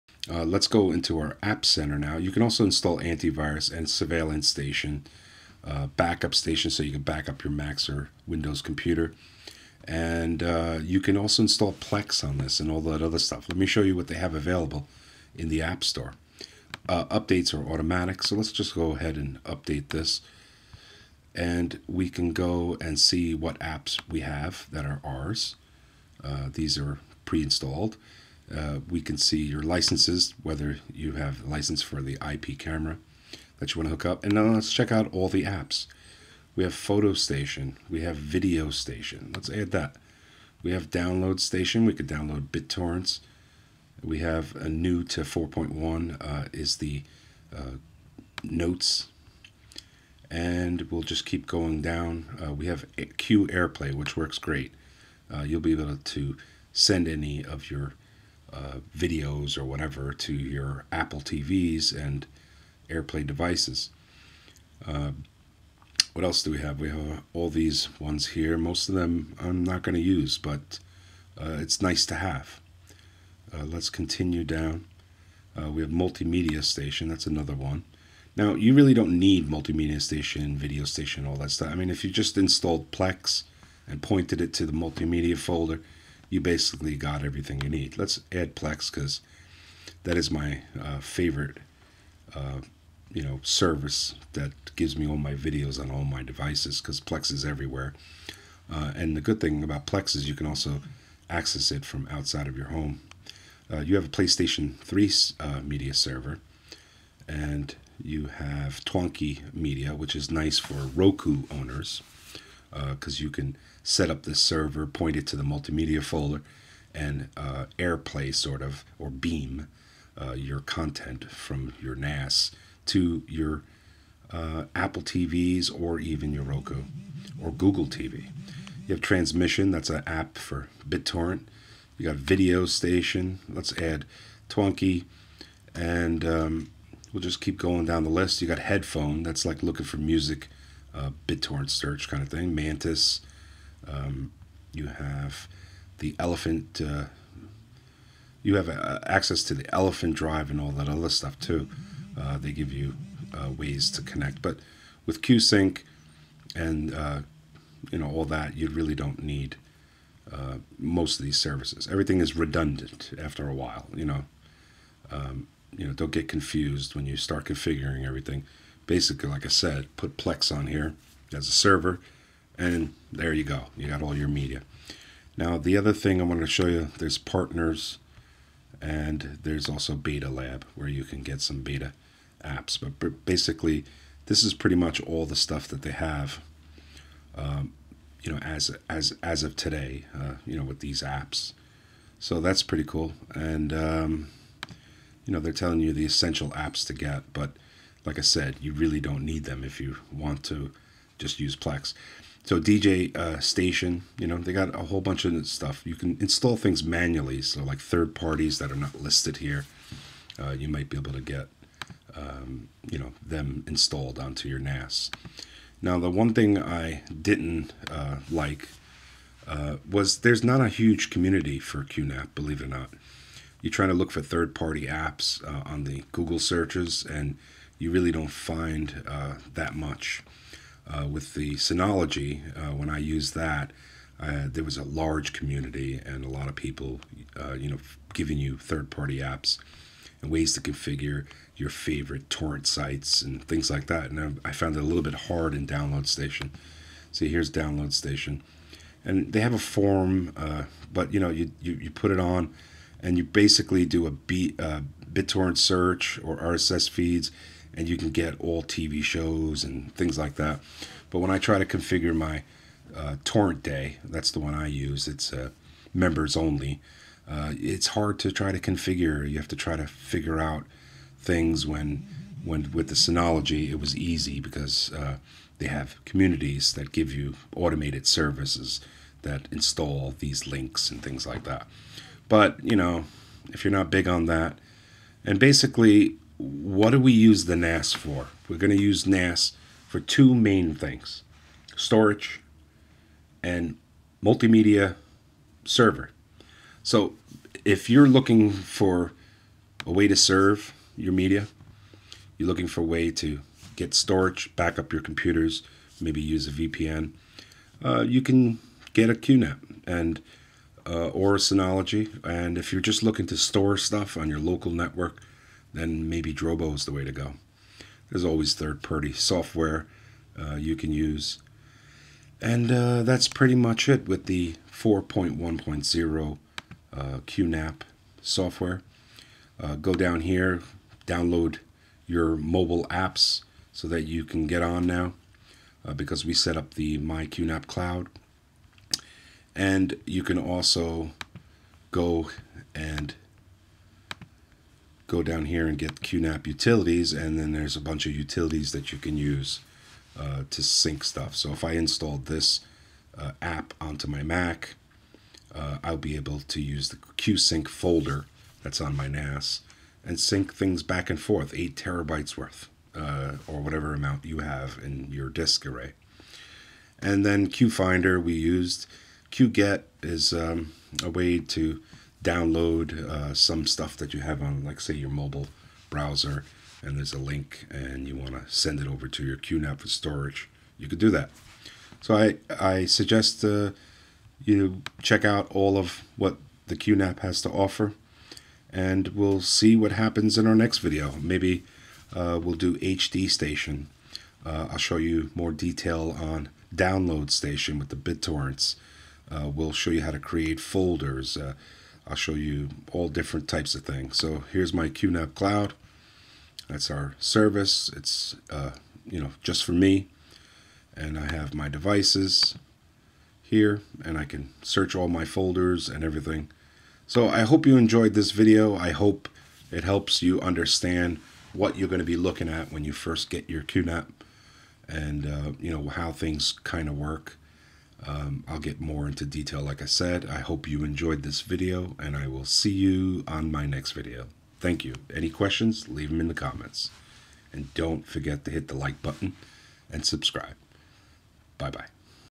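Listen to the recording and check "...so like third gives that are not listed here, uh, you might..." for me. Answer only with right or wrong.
wrong.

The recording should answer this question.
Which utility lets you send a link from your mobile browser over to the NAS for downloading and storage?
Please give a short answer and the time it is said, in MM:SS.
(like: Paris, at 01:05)
QGet, at 06:09.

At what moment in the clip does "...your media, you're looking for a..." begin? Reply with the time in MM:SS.
05:00.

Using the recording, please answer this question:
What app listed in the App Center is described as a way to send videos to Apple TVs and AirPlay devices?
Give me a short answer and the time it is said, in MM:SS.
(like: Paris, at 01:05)
Q Airplay, at 00:53.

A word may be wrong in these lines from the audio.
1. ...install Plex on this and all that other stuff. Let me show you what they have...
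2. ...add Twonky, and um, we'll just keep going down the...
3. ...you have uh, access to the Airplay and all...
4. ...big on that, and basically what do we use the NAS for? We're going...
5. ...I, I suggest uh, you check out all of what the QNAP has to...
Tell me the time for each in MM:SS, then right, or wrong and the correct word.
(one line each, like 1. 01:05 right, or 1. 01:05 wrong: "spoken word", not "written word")
1. 00:11 right
2. 02:13 right
3. 02:28 wrong: "ElephantDrive", not "Airplay"
4. 04:43 right
5. 06:22 right.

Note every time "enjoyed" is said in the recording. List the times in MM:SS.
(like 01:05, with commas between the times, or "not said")
06:57, 07:10.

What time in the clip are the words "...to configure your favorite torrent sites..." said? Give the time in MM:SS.
04:00.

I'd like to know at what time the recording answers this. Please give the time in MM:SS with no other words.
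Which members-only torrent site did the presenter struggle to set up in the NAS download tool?
04:23.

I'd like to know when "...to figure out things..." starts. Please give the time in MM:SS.
04:29.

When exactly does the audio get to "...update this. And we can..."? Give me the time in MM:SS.
00:19.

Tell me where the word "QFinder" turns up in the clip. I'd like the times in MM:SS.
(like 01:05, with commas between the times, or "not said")
06:07.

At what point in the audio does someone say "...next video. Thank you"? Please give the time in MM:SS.
07:13.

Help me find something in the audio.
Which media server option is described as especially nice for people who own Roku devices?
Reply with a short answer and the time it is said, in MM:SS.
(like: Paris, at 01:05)
Twonky Media, at 01:48.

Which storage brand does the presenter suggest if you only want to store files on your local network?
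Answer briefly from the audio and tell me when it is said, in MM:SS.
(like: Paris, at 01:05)
Drobo, at 05:16.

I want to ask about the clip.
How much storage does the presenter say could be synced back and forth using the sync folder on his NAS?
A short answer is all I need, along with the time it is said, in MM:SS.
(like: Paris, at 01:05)
8 terabytes, at 06:01.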